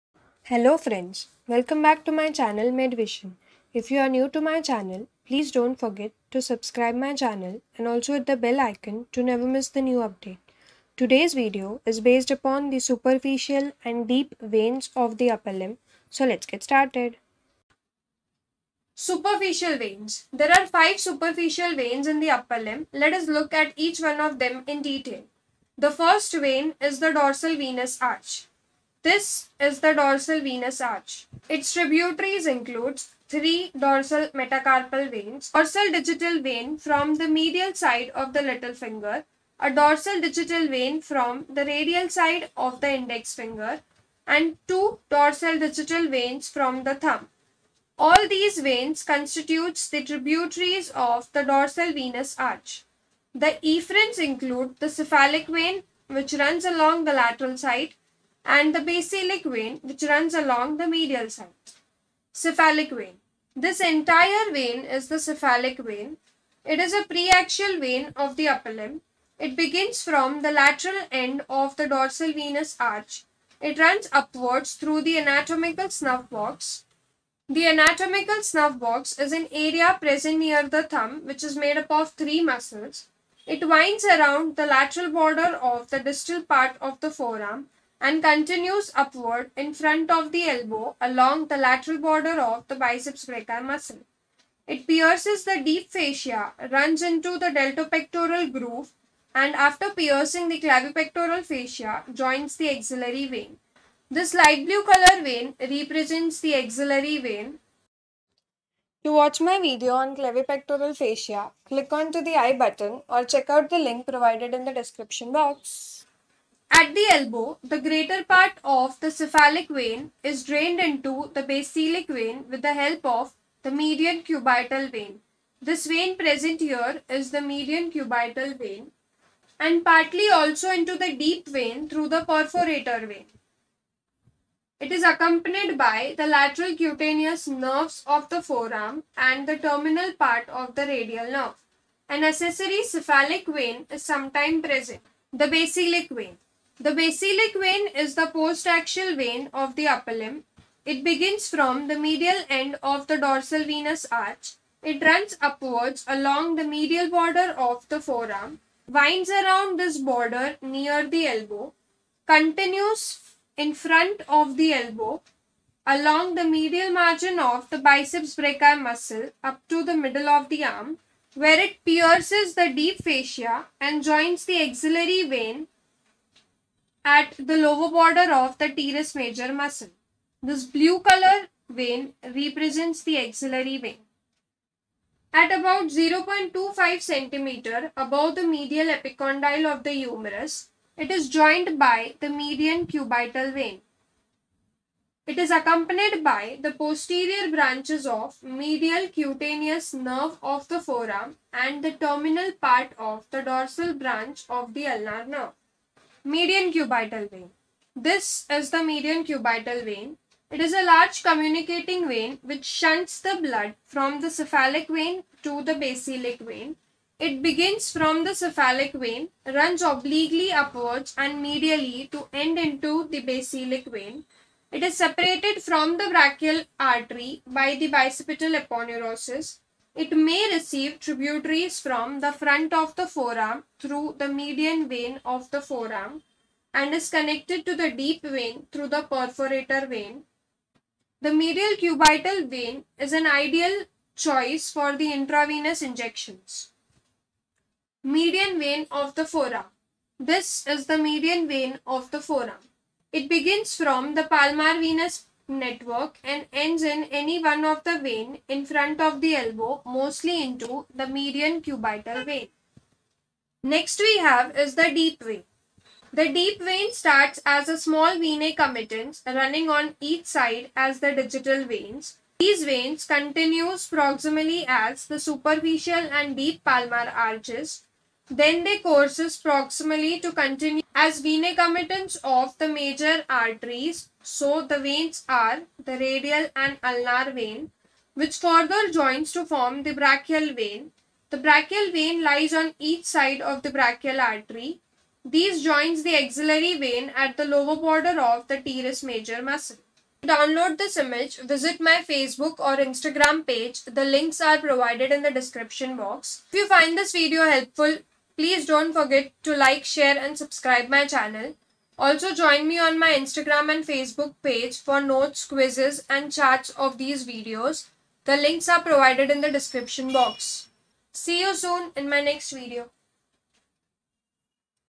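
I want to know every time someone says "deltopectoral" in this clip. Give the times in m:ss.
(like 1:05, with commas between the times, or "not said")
1:37.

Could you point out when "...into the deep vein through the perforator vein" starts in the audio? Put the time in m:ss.
2:10.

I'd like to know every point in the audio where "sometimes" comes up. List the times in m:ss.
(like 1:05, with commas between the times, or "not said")
2:24.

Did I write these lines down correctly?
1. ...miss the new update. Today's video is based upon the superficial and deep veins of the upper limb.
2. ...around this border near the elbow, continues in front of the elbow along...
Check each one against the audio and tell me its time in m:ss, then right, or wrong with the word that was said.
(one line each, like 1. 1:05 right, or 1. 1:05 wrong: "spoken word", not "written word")
1. 0:09 right
2. 2:39 right.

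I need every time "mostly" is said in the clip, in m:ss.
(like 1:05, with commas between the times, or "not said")
4:19.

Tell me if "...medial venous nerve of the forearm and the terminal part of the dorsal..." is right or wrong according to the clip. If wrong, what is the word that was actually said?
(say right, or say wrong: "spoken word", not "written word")
wrong: "cutaneous", not "venous".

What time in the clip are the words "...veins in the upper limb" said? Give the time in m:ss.
0:21.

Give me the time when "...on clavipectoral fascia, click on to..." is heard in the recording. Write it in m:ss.
1:50.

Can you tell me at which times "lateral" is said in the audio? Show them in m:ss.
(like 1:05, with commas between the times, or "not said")
0:57, 1:10, 1:24, 1:31, 2:16.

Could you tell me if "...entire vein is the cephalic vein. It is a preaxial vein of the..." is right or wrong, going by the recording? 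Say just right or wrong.
right.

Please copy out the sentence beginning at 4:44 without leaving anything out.
So the veins are the radial and ulnar vein, which further joins to form the brachial vein.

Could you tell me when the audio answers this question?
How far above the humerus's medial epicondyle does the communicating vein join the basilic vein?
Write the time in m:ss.
3:05.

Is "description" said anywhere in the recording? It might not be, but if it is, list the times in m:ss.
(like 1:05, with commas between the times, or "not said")
1:54, 5:05, 5:19.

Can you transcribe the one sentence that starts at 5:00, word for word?
To download this image, visit my Facebook or Instagram page.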